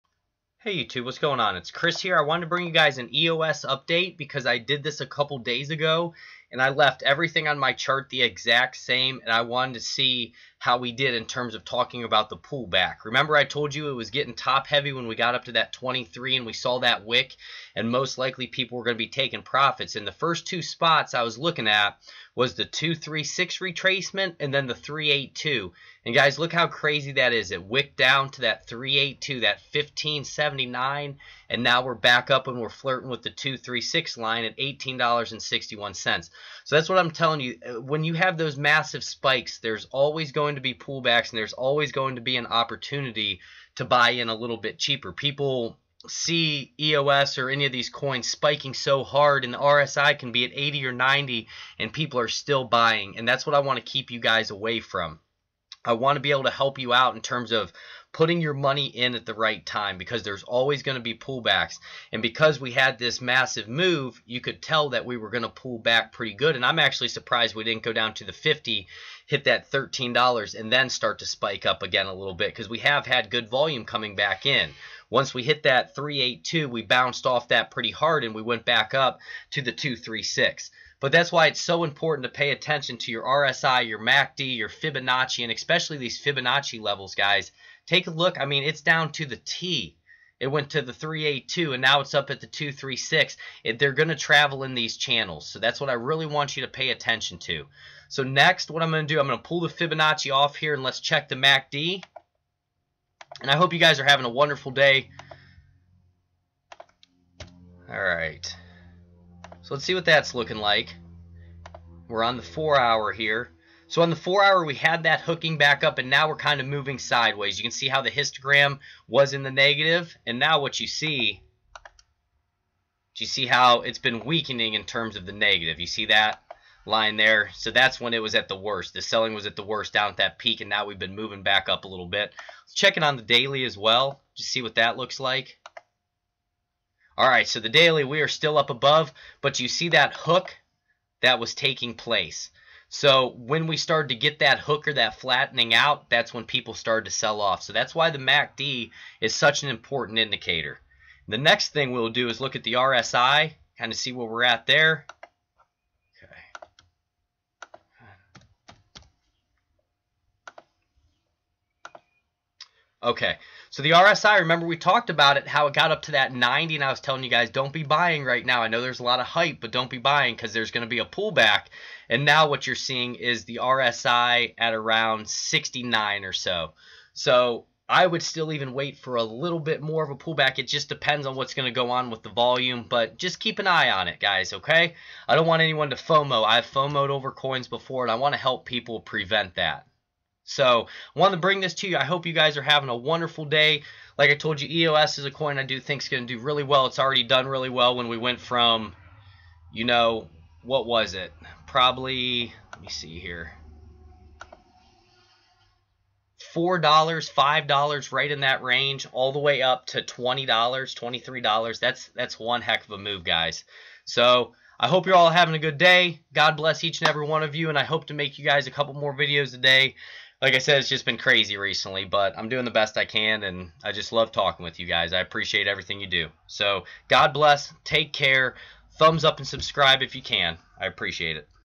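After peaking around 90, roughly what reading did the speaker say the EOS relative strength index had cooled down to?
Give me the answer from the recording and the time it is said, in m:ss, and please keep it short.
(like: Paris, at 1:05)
69, at 2:55.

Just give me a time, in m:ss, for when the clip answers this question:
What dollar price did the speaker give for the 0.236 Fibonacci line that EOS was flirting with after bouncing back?
0:34.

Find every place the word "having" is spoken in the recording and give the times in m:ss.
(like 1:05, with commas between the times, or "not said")
1:44, 3:12, 3:35.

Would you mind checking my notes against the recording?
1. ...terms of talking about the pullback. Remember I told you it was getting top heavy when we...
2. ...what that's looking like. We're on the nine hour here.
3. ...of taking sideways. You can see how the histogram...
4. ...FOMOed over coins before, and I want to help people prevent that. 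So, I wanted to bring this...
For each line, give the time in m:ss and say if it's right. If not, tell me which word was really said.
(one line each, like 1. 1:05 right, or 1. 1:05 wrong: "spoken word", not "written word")
1. 0:11 right
2. 1:49 wrong: "four", not "nine"
3. 1:56 wrong: "moving", not "taking"
4. 3:06 right.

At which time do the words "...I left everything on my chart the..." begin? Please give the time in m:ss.
0:06.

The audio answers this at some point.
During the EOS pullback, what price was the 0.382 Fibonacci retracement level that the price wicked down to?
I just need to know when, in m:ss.
0:29.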